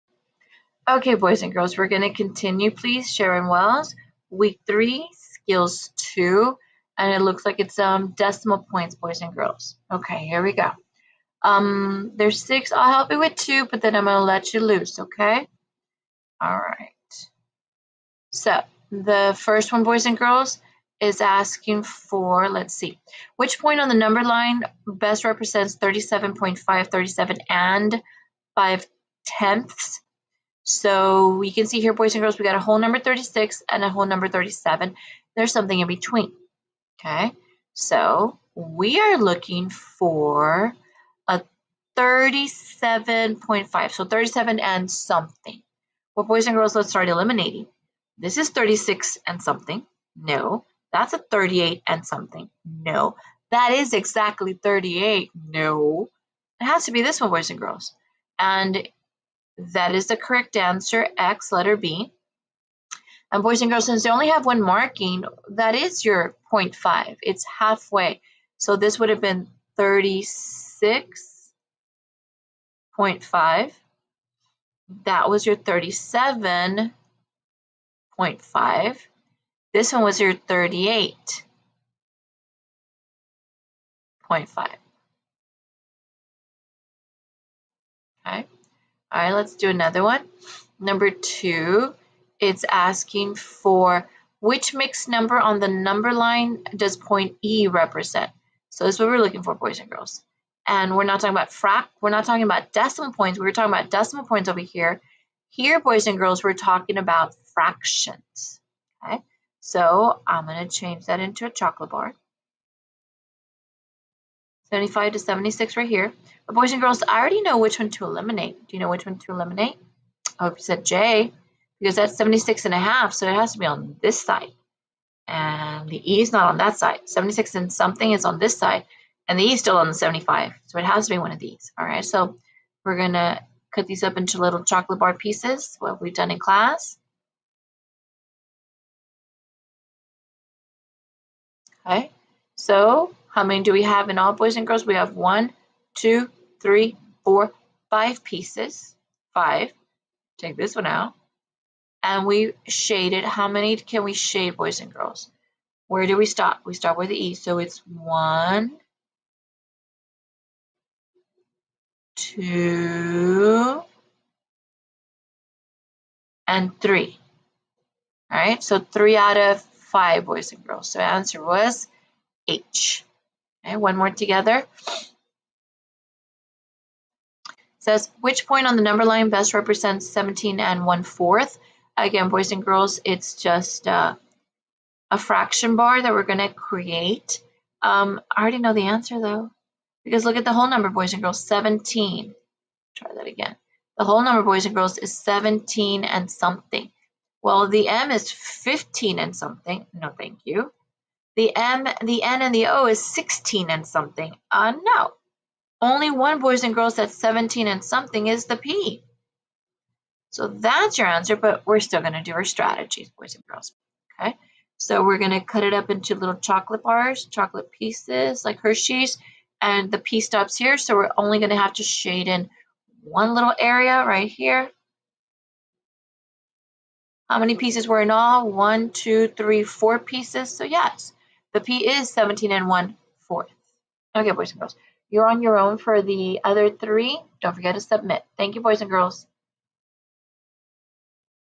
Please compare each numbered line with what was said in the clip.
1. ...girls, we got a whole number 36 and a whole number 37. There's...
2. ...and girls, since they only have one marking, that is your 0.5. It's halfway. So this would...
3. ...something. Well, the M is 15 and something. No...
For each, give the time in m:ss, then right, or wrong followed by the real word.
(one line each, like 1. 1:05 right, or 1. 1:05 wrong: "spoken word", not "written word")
1. 0:32 right
2. 1:03 right
3. 3:16 right.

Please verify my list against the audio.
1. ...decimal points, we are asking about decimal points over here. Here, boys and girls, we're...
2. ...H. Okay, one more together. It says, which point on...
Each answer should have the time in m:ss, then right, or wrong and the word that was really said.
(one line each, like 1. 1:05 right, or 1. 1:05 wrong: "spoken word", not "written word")
1. 1:42 wrong: "talking", not "asking"
2. 2:52 right.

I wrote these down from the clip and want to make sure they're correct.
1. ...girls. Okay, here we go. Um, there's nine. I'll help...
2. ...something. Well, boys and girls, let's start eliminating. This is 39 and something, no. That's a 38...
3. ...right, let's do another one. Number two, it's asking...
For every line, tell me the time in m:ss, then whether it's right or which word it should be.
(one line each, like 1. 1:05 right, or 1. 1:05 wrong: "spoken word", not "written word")
1. 0:09 wrong: "six", not "nine"
2. 0:44 wrong: "36", not "39"
3. 1:29 right.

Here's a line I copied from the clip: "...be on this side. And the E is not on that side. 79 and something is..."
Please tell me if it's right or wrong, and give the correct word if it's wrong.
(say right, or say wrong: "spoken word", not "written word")
wrong: "76", not "79".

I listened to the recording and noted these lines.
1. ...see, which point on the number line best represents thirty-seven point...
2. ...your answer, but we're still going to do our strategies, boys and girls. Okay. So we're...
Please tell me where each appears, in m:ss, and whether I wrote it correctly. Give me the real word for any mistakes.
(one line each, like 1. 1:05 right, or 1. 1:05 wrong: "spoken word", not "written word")
1. 0:22 right
2. 3:30 right.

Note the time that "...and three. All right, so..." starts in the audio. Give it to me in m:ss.
2:46.